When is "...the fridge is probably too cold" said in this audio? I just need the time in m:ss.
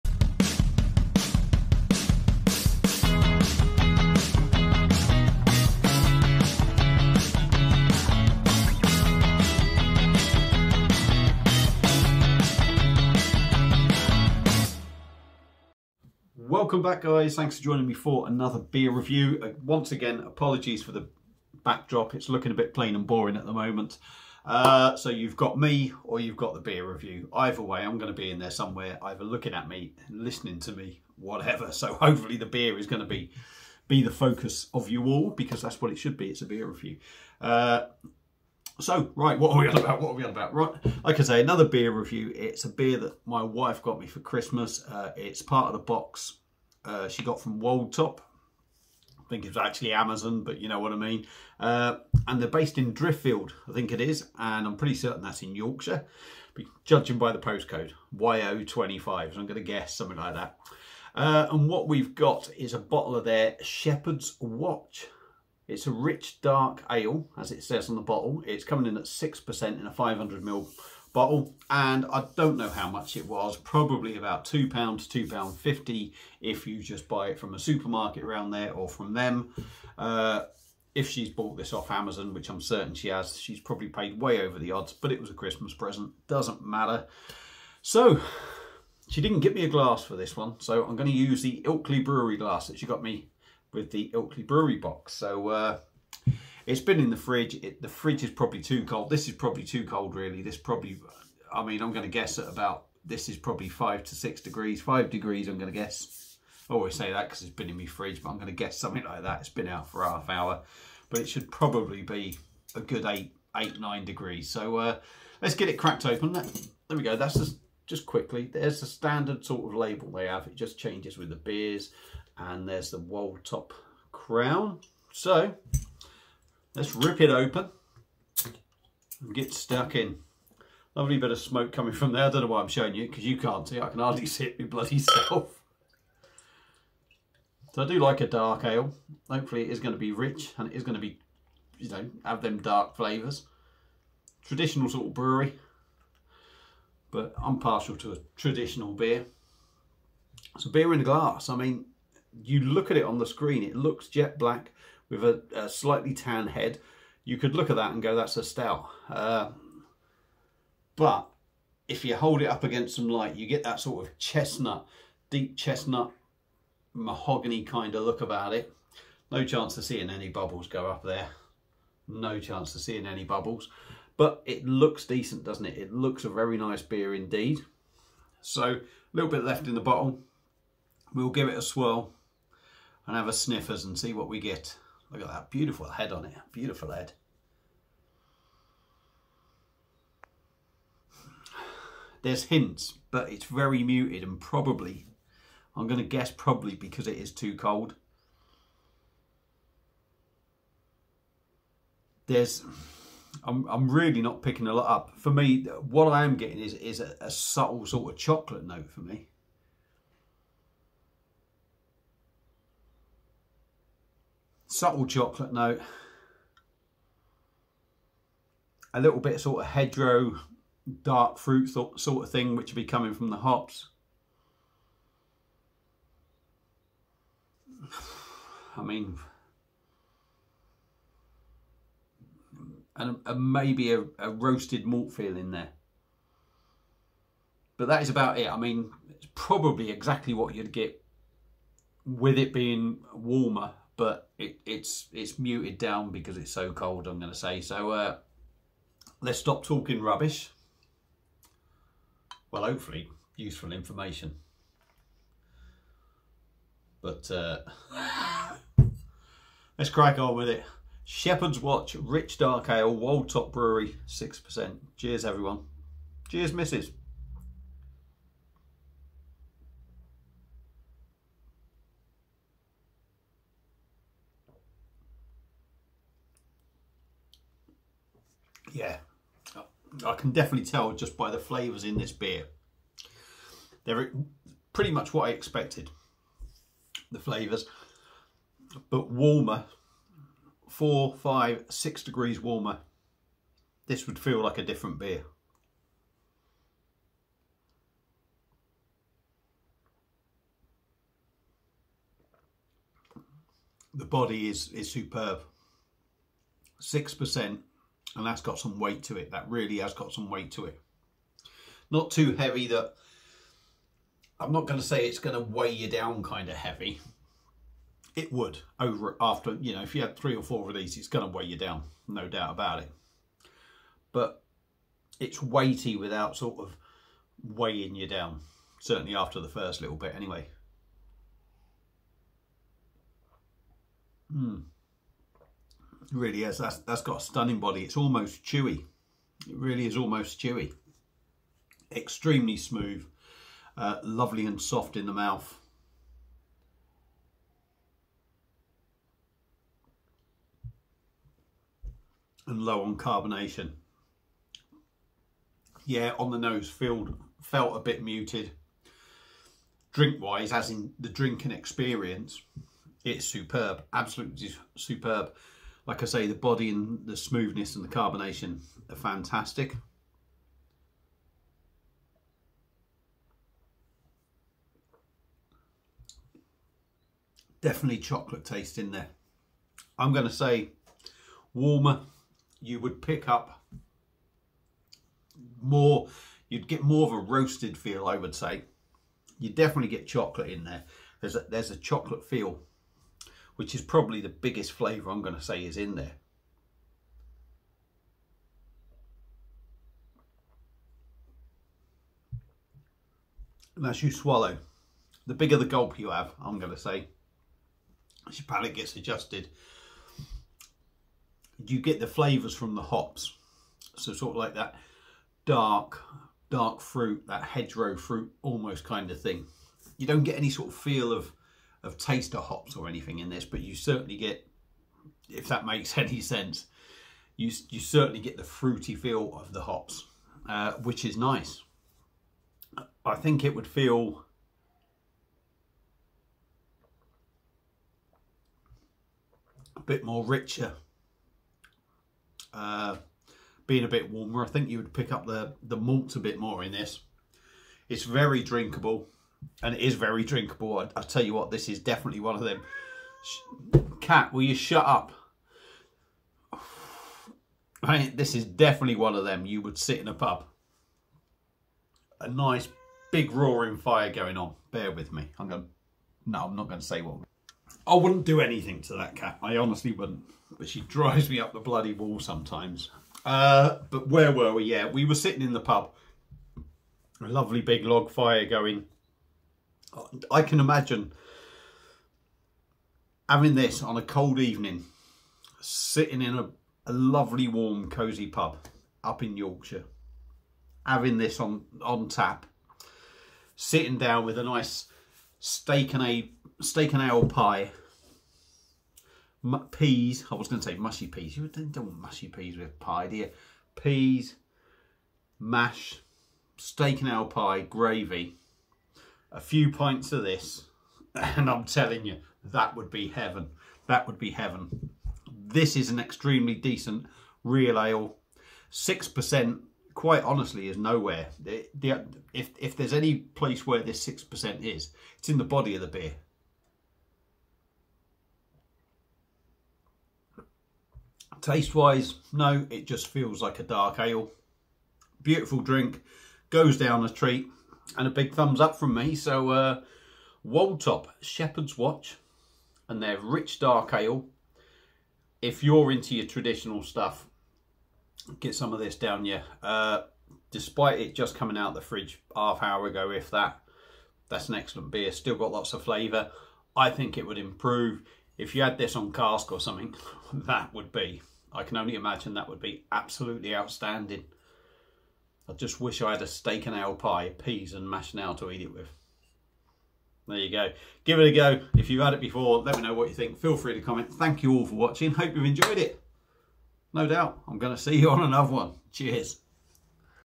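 1:37.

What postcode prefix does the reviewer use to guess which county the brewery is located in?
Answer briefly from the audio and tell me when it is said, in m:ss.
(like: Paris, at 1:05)
YO25, at 0:58.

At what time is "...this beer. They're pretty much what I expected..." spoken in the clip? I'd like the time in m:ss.
4:41.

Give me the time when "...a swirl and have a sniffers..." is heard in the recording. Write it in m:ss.
3:01.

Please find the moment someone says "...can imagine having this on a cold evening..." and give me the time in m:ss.
8:00.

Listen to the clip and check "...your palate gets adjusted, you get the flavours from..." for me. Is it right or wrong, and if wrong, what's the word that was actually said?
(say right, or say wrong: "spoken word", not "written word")
right.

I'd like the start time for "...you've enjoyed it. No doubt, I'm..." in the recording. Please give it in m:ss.
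9:35.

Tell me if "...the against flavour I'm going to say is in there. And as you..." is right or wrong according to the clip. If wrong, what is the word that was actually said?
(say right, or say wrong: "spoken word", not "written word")
wrong: "biggest", not "against".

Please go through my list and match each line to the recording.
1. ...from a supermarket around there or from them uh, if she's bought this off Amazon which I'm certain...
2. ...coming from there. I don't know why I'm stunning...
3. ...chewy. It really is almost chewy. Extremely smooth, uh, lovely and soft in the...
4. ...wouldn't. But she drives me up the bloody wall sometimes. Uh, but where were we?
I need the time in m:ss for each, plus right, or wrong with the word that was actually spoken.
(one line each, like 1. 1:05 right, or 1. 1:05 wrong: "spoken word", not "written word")
1. 1:17 right
2. 2:11 wrong: "showing", not "stunning"
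3. 5:38 right
4. 7:49 right.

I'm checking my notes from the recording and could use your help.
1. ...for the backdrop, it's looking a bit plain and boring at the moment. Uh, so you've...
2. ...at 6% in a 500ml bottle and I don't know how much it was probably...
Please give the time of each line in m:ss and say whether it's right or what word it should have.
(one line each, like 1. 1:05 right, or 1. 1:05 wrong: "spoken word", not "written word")
1. 0:20 right
2. 1:08 right.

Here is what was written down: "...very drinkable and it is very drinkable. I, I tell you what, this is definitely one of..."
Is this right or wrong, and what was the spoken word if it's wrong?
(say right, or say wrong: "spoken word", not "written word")
right.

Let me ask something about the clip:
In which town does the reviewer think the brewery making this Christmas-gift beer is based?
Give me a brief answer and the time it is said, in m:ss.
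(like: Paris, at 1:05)
Driffield, at 0:52.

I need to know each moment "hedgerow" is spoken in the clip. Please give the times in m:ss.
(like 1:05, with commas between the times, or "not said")
3:39, 6:57.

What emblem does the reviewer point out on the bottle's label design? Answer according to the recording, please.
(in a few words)
Wold Top crown.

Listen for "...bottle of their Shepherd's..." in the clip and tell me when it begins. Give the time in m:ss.
1:02.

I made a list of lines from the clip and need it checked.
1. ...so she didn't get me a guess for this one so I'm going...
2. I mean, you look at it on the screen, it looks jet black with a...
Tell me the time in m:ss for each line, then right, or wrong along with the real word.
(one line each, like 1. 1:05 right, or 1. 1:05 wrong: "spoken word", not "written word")
1. 1:27 wrong: "glass", not "guess"
2. 2:31 right.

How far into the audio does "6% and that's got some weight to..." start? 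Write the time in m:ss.
5:06.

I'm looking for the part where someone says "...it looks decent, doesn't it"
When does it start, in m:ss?
2:54.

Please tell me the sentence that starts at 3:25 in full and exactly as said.
For me, what I am getting is, is a, a subtle sort of chocolate note for me.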